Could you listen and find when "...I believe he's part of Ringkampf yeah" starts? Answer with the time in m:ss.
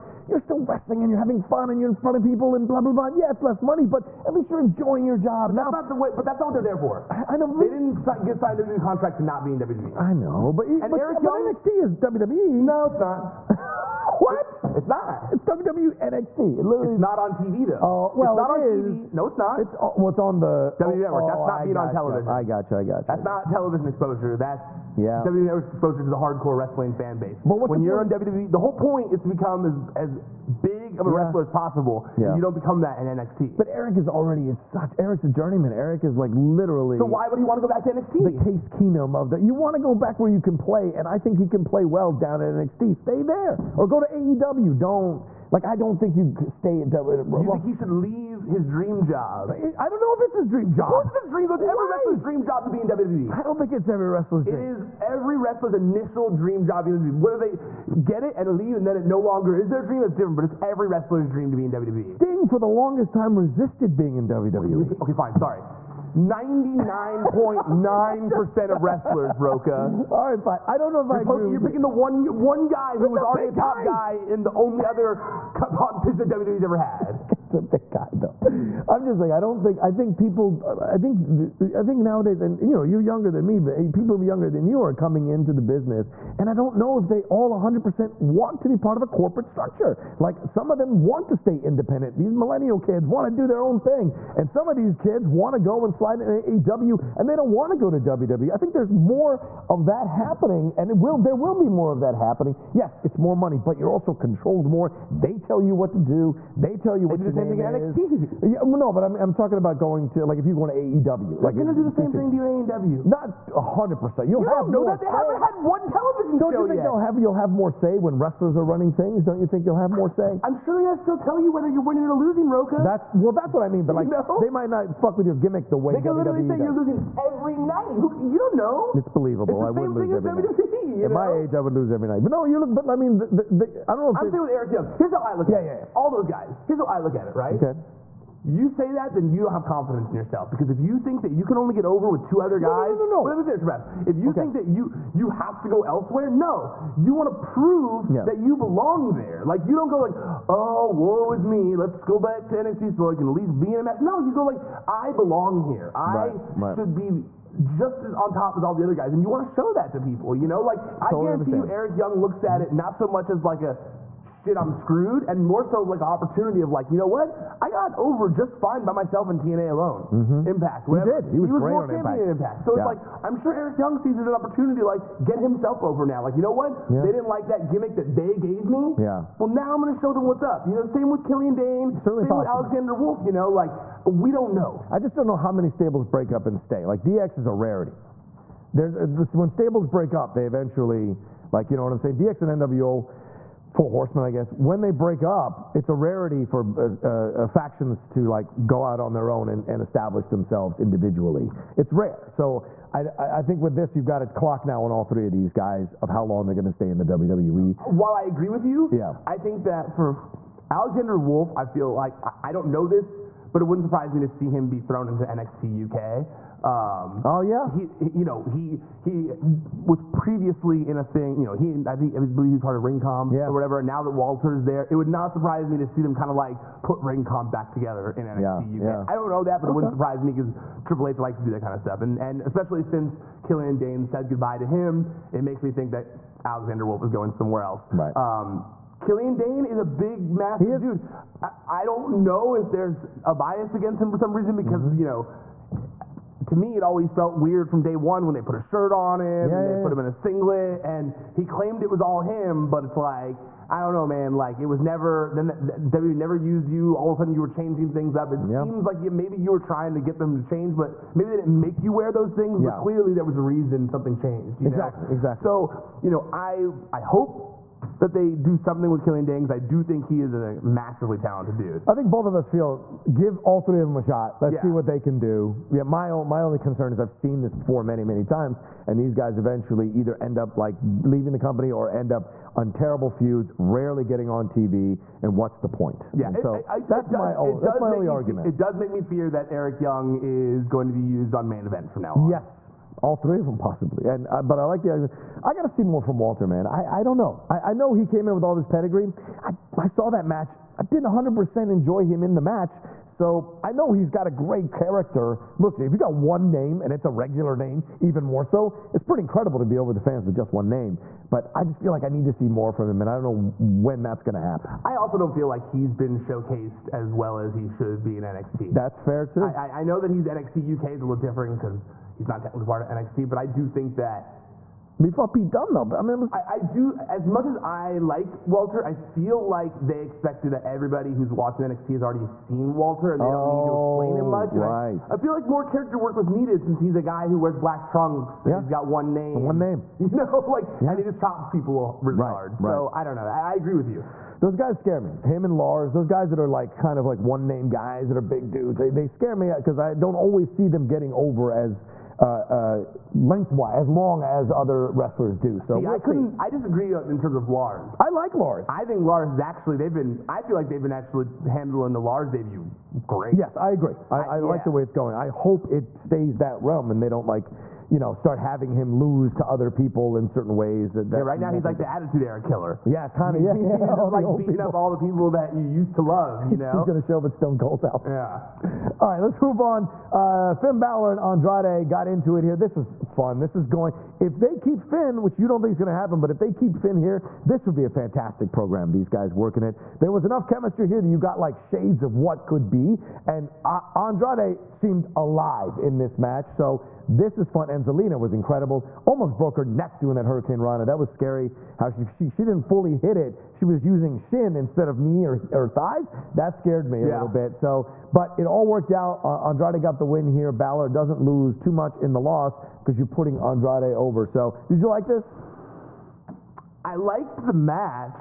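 3:42.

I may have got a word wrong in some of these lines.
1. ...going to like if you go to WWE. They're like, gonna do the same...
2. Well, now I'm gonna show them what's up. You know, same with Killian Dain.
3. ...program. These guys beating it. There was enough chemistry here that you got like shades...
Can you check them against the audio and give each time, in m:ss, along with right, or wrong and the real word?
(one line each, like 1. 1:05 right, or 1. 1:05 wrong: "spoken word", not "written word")
1. 1:49 wrong: "AEW", not "WWE"
2. 2:59 right
3. 6:28 wrong: "working", not "beating".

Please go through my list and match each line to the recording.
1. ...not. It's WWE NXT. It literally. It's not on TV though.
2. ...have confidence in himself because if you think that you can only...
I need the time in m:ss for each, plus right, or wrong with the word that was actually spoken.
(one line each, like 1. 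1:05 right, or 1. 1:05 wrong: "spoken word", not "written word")
1. 0:14 right
2. 2:19 wrong: "yourself", not "himself".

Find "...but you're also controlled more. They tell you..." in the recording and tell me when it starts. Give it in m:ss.
1:43.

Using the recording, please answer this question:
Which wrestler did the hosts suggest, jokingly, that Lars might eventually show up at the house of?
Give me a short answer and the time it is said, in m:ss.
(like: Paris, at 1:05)
Stone Cold, at 6:17.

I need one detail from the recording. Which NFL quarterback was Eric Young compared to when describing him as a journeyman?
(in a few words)
Case Keenum.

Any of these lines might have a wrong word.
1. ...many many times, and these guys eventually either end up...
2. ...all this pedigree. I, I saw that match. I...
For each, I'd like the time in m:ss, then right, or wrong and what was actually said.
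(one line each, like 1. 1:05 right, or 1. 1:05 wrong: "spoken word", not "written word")
1. 4:37 right
2. 4:58 right.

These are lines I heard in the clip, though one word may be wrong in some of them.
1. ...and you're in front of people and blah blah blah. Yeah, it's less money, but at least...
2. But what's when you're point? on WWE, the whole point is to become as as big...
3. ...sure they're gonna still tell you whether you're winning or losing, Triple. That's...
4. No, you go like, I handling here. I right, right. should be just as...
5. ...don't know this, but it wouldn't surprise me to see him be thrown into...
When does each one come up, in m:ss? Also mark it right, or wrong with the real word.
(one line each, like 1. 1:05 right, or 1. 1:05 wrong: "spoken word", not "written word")
1. 0:01 right
2. 0:27 right
3. 2:00 wrong: "Rocha", not "Triple"
4. 2:34 wrong: "belong", not "handling"
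5. 3:32 right.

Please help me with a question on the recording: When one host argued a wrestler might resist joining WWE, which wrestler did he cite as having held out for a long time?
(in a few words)
Sting.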